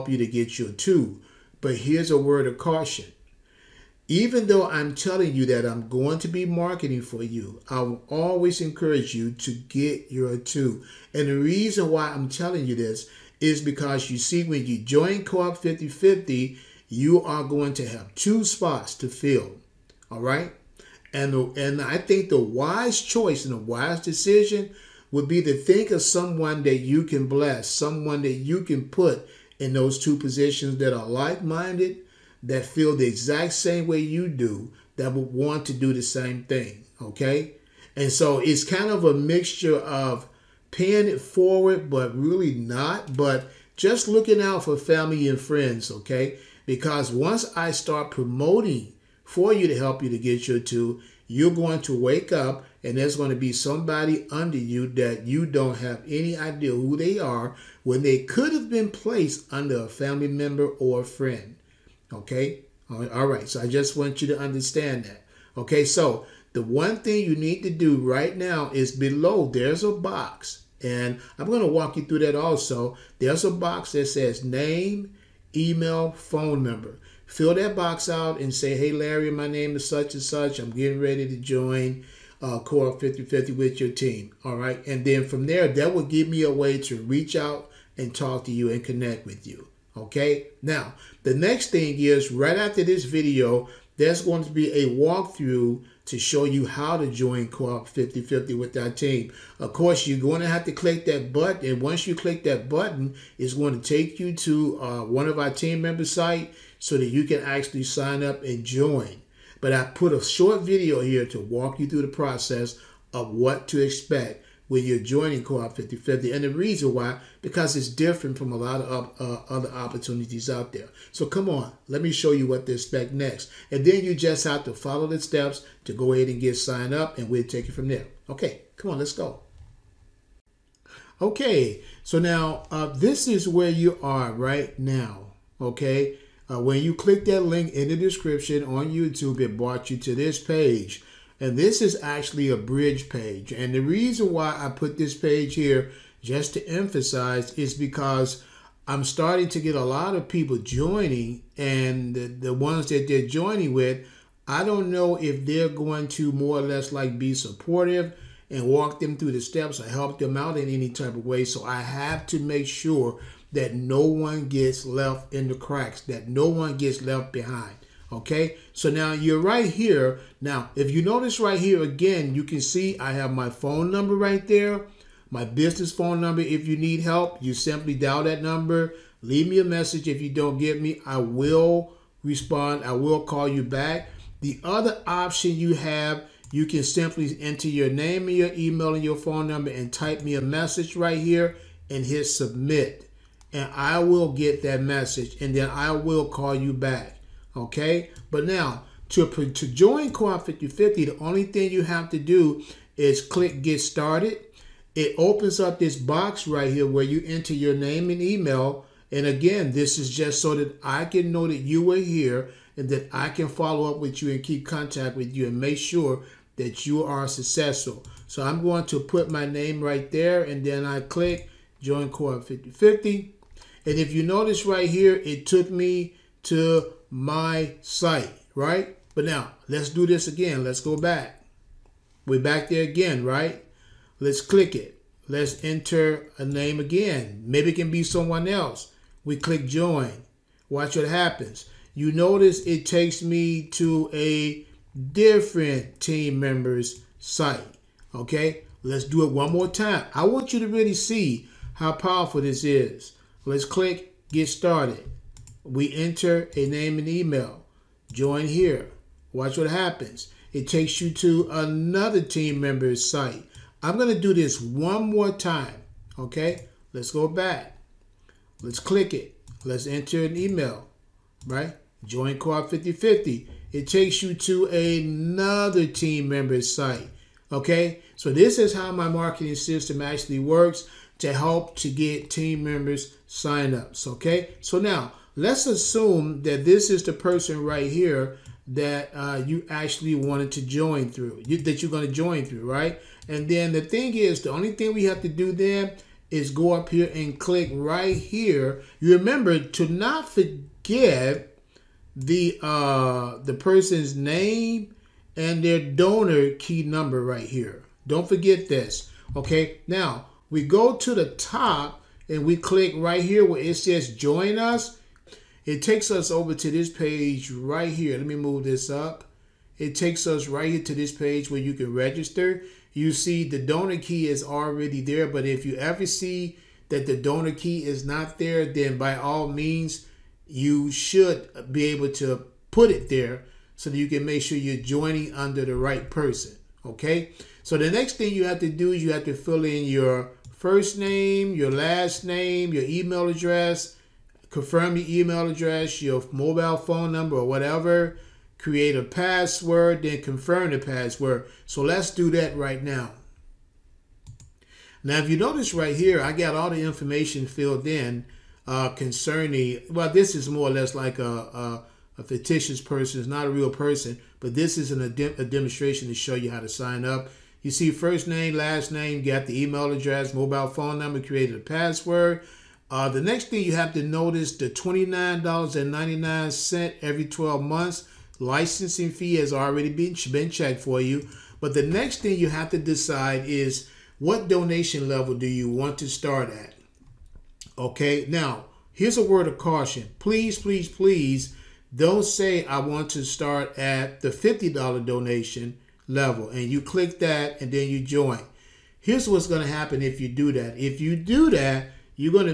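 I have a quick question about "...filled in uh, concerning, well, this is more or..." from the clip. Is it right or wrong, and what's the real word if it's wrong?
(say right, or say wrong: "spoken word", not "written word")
right.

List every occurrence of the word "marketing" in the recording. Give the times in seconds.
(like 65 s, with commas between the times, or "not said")
6 s, 279 s.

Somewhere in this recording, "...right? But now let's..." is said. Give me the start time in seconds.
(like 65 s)
228 s.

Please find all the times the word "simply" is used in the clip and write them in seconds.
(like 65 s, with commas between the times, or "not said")
177 s, 186 s.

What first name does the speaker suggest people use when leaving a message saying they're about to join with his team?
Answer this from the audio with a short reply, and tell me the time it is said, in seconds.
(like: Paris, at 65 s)
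Larry, at 78 s.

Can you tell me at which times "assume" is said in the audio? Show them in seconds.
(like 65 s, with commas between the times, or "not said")
285 s.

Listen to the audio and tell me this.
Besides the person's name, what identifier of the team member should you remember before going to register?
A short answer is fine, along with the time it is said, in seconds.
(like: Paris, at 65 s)
donor key number, at 305 s.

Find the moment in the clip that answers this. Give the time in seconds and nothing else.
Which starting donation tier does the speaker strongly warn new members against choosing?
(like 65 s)
394 s.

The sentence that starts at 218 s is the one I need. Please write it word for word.
So I'm going to put my name right there and then I click Join Co-op 5050.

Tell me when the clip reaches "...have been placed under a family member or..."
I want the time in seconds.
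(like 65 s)
58 s.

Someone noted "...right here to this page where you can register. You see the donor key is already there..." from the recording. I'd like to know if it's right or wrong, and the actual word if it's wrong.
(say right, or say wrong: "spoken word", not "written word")
right.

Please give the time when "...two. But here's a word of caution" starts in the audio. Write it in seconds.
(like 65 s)
0 s.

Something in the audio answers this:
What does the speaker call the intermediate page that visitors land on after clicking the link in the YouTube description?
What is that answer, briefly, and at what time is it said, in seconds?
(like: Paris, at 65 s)
bridge page, at 142 s.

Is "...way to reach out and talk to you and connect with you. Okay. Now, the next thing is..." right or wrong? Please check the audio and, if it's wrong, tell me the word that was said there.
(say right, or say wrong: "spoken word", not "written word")
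right.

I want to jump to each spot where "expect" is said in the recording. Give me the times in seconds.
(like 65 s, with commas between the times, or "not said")
113 s, 122 s.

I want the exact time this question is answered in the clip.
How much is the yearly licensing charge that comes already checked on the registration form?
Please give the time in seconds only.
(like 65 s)
374 s.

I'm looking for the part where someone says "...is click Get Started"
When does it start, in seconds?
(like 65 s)
202 s.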